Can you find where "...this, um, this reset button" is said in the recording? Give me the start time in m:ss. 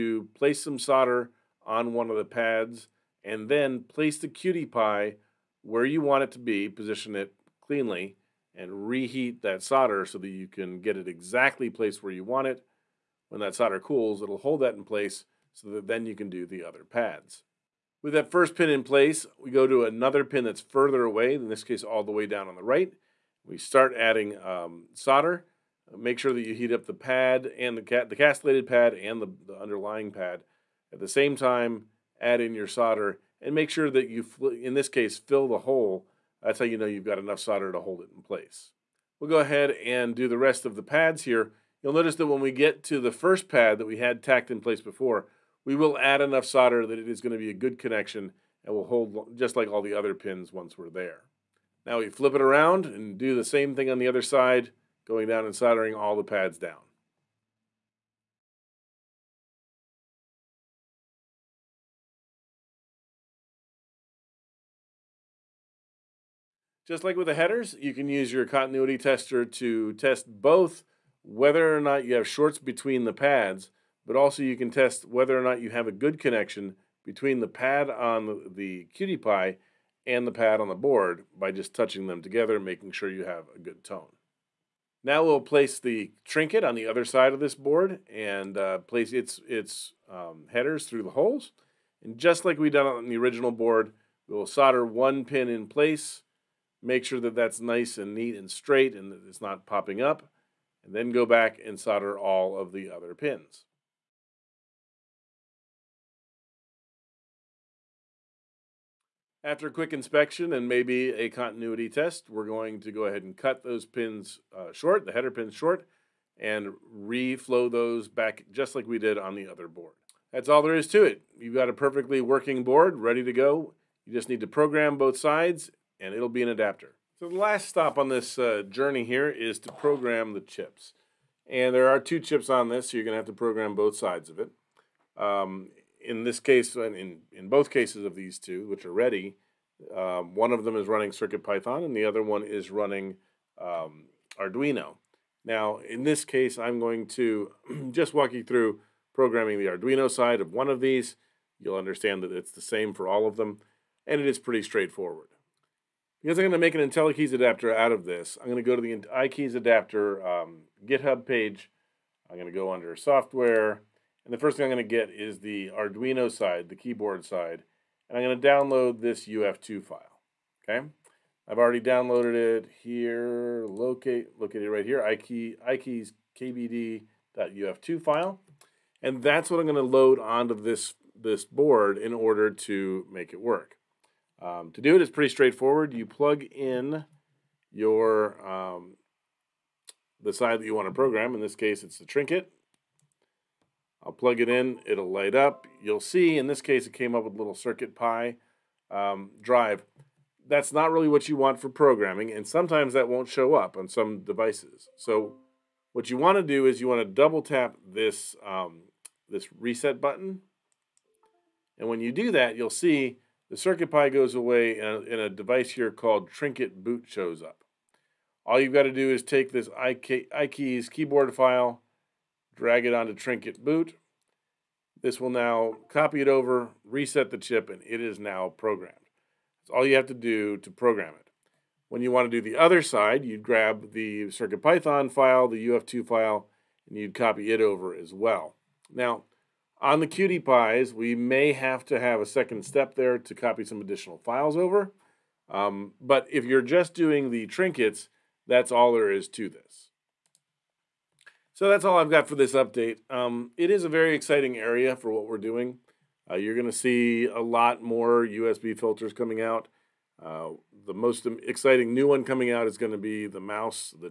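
3:27.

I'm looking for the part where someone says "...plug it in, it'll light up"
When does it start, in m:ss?
3:14.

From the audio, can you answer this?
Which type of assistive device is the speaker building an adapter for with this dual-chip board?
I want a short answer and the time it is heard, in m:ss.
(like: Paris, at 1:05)
IntelliKeys, at 2:36.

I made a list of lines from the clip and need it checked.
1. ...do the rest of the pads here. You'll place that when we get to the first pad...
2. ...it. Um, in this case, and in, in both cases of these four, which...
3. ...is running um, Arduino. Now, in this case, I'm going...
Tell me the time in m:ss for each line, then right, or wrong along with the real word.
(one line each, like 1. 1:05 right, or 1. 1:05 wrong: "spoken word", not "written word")
1. 0:40 wrong: "notice", not "place"
2. 2:14 wrong: "two", not "four"
3. 2:22 right.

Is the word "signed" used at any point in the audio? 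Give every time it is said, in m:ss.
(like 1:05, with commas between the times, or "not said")
not said.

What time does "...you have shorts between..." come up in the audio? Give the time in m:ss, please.
1:12.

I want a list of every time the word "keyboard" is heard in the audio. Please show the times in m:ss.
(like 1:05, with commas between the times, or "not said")
2:46, 3:40.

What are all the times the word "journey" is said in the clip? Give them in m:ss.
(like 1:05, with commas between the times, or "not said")
2:08.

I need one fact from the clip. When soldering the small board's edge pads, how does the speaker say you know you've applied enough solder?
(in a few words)
Fill the hole.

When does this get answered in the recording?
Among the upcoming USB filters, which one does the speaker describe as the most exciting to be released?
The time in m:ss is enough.
4:23.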